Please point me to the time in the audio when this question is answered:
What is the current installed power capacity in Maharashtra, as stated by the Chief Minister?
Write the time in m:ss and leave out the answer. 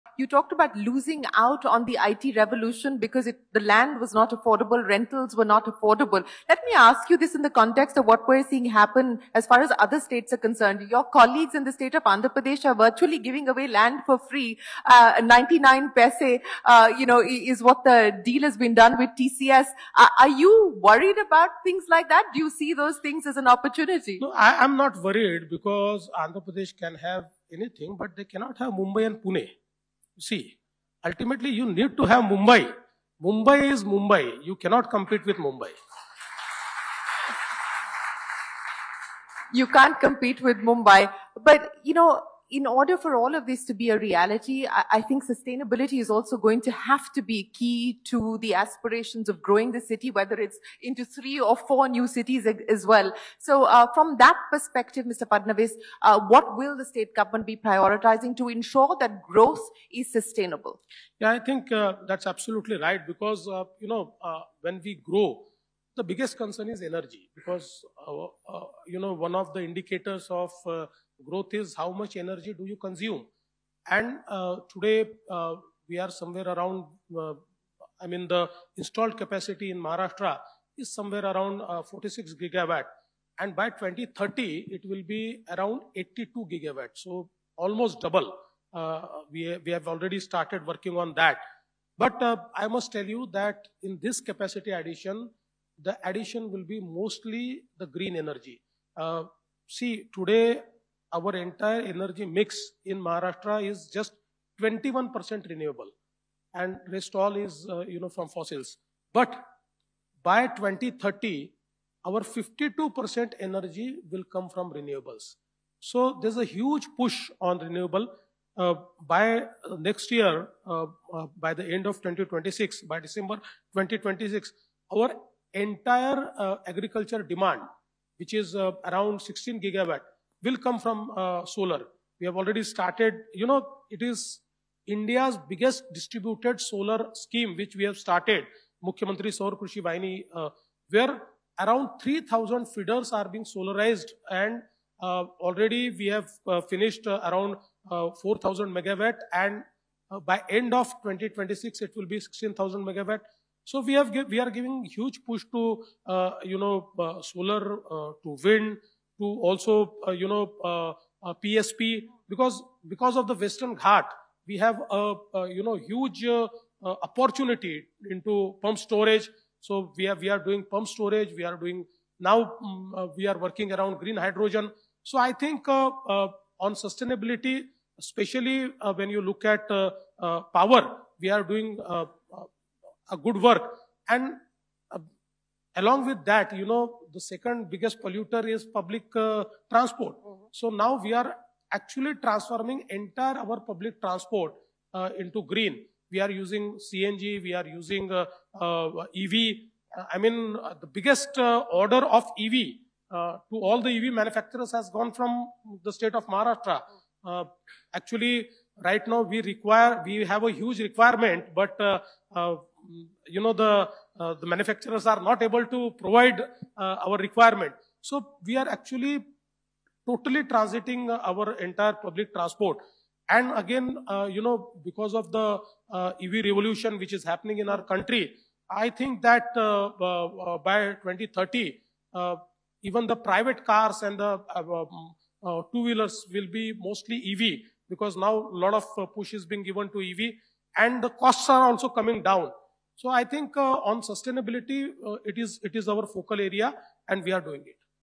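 1:21.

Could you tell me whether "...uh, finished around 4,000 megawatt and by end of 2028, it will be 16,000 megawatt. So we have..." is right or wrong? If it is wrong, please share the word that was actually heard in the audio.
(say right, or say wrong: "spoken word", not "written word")
wrong: "2026", not "2028".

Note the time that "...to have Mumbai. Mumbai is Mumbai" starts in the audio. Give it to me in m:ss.
0:31.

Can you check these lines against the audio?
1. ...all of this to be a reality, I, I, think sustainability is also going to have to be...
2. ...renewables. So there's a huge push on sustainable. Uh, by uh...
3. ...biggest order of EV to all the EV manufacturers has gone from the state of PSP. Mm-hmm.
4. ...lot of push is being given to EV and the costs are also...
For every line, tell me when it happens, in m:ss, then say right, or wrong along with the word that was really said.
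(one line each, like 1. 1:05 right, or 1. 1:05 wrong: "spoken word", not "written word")
1. 0:43 right
2. 1:54 wrong: "renewable", not "sustainable"
3. 3:20 wrong: "Maharashtra", not "PSP"
4. 3:58 right.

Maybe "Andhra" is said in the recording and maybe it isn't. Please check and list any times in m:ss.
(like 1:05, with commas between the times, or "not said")
0:12, 0:26.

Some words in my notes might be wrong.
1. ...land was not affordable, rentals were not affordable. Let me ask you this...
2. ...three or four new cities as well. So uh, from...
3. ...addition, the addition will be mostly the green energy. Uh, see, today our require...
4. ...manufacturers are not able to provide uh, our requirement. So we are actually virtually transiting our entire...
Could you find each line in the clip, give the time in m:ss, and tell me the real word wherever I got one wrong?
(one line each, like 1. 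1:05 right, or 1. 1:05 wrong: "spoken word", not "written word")
1. 0:03 right
2. 0:51 right
3. 1:34 wrong: "entire", not "require"
4. 3:34 wrong: "totally", not "virtually".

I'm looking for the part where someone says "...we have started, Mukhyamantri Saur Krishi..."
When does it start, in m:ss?
2:17.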